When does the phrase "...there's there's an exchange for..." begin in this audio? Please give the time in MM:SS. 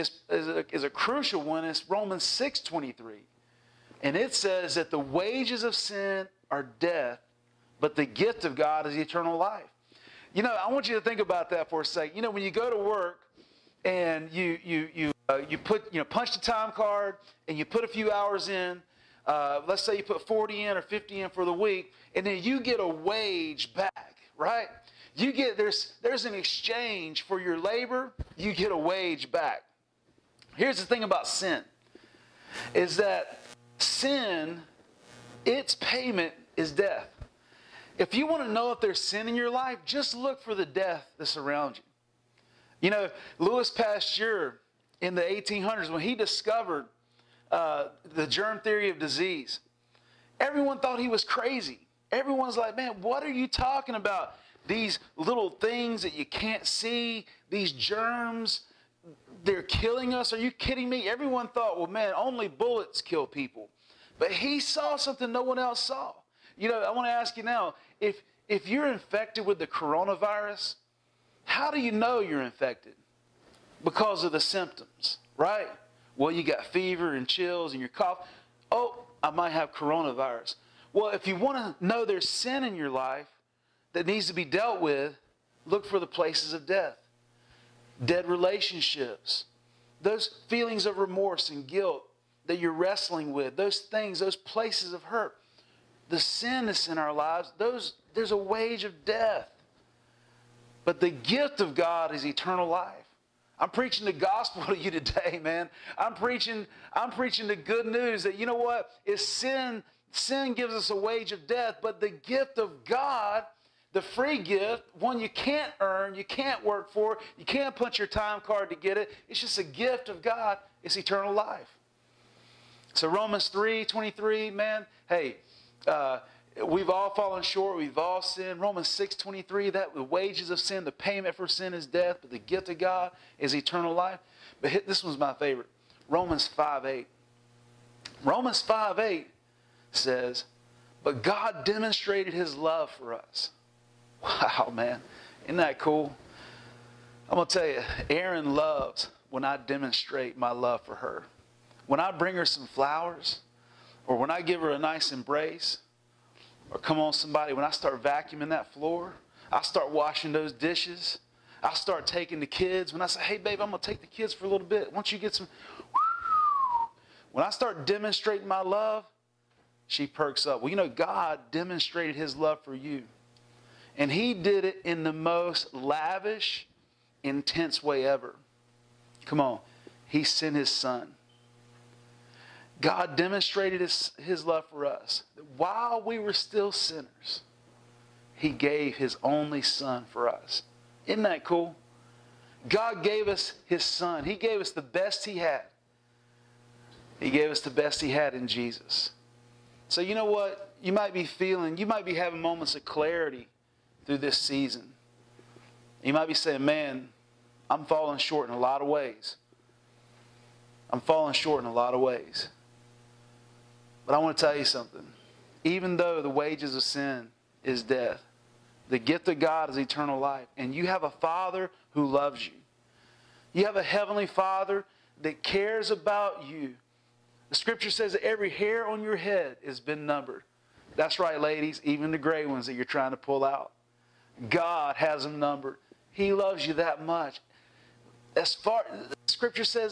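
00:25.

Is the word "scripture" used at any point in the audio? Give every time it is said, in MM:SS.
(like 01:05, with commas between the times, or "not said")
03:47, 03:59.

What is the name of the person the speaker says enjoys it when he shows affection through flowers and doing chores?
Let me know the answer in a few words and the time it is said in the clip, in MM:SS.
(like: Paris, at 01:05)
Aaron, at 02:28.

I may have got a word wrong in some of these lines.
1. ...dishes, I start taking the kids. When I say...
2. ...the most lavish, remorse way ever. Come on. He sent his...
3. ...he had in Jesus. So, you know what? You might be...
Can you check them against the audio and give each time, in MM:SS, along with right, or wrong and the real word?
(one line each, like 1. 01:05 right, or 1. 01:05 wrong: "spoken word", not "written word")
1. 02:40 right
2. 02:55 wrong: "intense", not "remorse"
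3. 03:17 right.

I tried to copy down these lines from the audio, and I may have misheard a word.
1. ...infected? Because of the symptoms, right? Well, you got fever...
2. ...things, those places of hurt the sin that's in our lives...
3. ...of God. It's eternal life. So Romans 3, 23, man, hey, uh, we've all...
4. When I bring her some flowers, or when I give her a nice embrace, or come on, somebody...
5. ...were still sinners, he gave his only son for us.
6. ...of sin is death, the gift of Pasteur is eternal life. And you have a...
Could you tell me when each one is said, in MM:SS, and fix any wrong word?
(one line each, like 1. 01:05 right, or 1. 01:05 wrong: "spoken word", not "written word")
1. 01:12 right
2. 01:33 right
3. 02:00 right
4. 02:31 right
5. 03:06 right
6. 03:36 wrong: "God", not "Pasteur".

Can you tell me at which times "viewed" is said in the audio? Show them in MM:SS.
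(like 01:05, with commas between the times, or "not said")
not said.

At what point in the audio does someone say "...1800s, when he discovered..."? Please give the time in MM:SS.
00:45.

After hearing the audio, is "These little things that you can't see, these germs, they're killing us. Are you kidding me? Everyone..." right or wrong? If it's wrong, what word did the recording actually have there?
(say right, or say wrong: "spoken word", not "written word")
right.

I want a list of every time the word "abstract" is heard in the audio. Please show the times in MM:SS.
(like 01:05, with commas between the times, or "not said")
not said.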